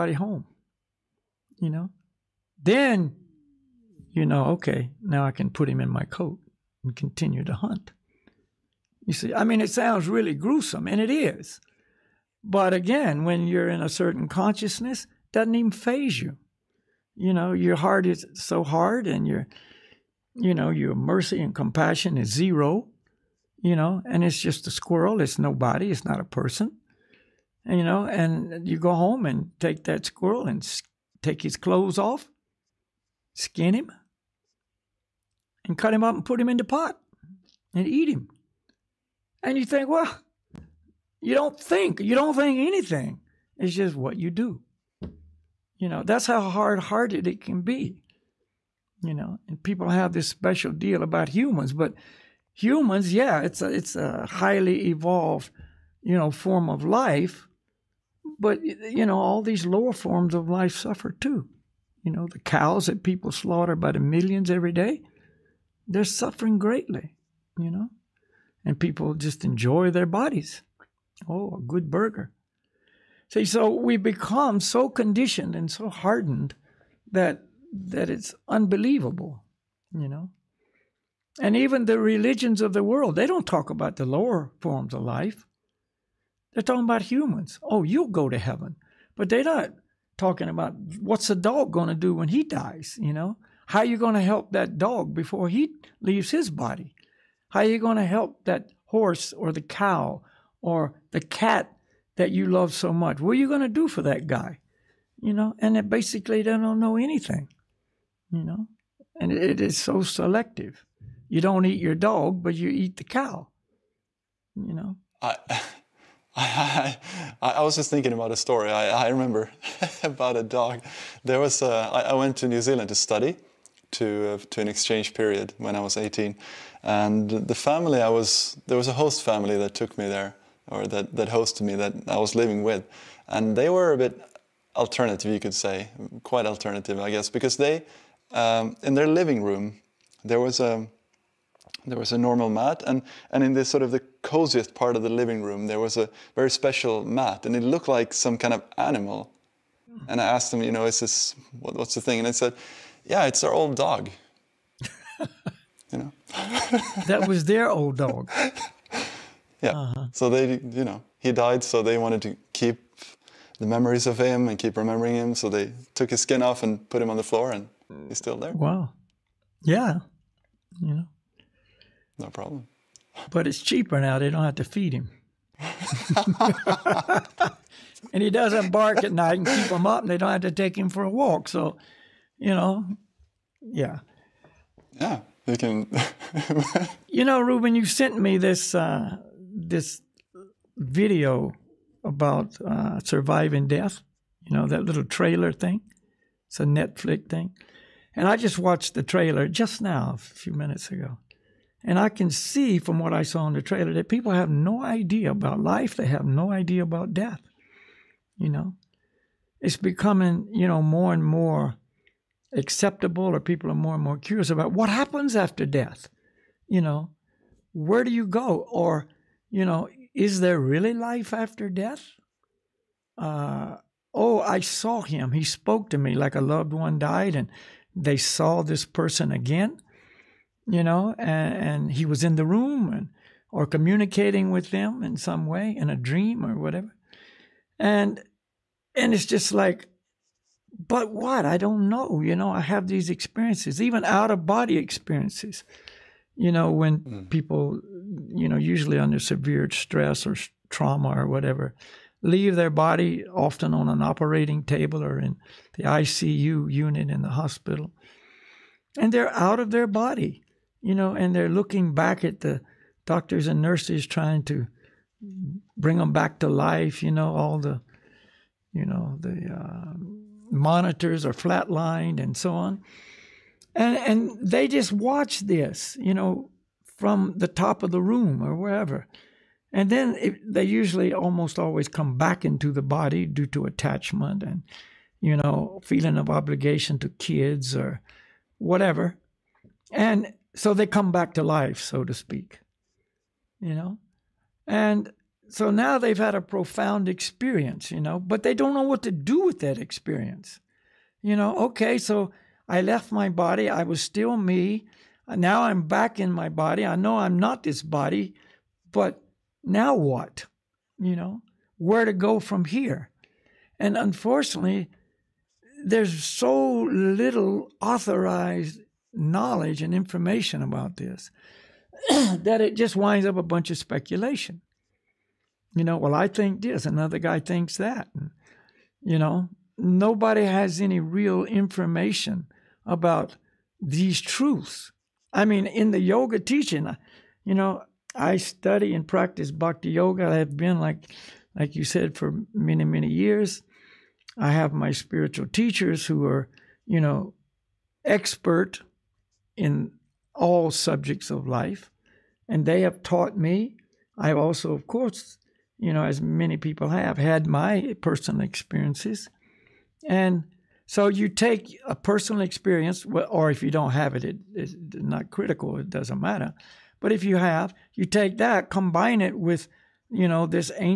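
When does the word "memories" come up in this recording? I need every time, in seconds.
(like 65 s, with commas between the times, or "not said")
163 s.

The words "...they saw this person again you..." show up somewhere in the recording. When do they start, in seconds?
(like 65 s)
227 s.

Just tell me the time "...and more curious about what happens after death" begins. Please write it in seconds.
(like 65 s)
213 s.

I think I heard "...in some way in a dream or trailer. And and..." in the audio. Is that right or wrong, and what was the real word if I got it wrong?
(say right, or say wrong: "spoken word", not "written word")
wrong: "whatever", not "trailer".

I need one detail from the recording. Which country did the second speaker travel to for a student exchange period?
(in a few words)
New Zealand.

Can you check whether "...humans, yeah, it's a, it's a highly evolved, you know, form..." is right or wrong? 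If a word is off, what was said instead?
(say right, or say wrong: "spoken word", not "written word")
right.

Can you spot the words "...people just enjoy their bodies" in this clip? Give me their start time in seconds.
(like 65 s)
68 s.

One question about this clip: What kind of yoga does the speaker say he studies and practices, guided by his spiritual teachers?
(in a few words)
bhakti yoga.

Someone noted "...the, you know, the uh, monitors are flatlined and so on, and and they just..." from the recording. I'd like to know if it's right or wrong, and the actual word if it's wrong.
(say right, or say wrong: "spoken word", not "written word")
right.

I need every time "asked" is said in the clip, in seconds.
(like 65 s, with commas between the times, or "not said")
150 s.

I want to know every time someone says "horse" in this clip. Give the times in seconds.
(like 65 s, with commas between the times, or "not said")
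98 s.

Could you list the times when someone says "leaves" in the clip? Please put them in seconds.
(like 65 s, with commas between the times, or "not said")
96 s, 252 s.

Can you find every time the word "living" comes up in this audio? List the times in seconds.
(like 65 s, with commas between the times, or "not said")
132 s, 139 s, 145 s.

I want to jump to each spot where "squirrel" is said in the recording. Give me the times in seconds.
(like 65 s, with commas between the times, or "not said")
24 s, 30 s.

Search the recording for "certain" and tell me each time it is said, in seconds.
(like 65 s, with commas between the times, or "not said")
13 s.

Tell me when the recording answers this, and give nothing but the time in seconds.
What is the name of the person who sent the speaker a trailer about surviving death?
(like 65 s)
187 s.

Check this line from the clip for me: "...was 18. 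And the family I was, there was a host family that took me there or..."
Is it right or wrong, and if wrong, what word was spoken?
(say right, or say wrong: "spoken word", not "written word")
right.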